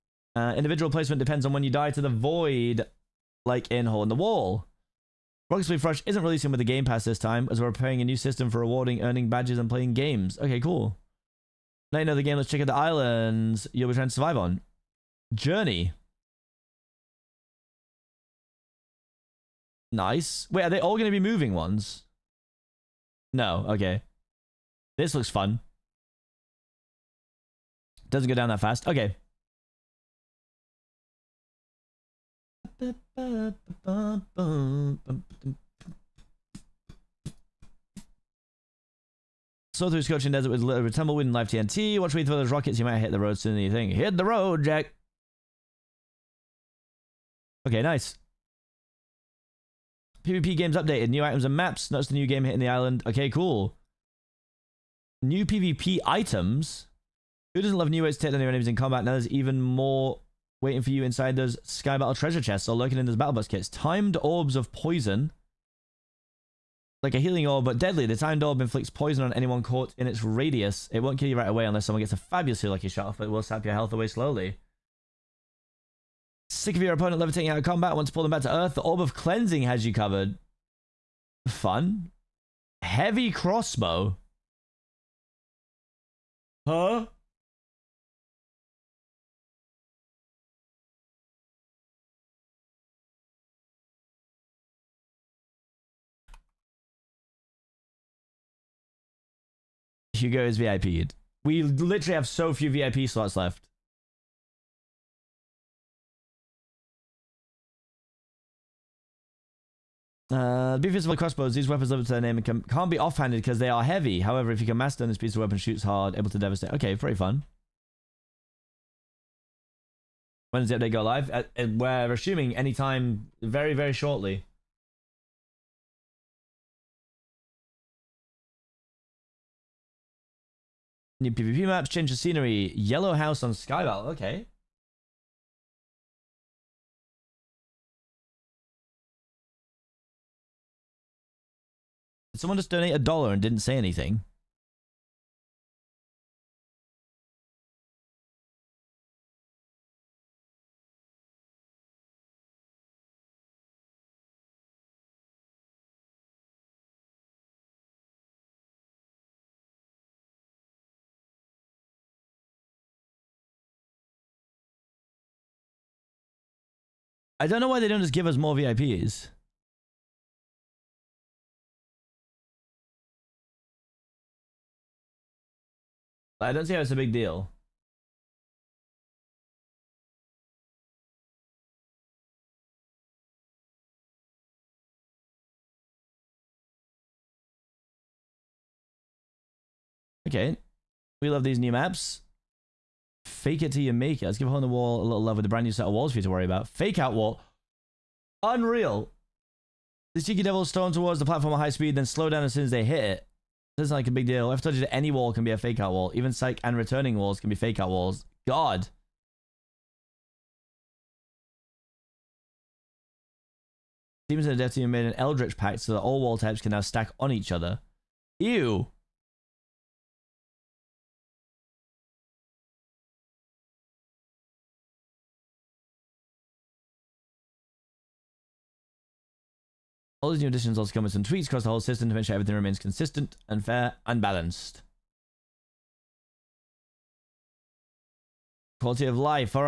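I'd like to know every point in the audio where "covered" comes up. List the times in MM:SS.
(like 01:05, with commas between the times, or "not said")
01:19.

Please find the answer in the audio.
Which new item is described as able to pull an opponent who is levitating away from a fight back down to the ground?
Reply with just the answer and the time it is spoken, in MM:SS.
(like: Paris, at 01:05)
Orb of Cleansing, at 01:18.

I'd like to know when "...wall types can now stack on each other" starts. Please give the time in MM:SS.
03:36.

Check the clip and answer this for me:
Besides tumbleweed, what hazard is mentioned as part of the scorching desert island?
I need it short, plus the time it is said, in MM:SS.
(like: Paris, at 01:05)
Live TNT, at 00:41.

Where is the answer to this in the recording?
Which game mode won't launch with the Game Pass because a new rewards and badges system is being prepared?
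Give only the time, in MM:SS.
00:05.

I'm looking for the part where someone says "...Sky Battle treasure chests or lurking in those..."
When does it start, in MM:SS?
01:01.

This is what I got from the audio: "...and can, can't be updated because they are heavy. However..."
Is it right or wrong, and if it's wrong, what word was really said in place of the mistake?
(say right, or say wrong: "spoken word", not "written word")
wrong: "offhanded", not "updated".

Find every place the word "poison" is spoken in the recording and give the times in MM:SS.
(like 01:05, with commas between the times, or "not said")
01:04, 01:08.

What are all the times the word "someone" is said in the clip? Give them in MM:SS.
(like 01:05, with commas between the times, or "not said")
01:11, 02:22.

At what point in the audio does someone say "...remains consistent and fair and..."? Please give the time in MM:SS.
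03:52.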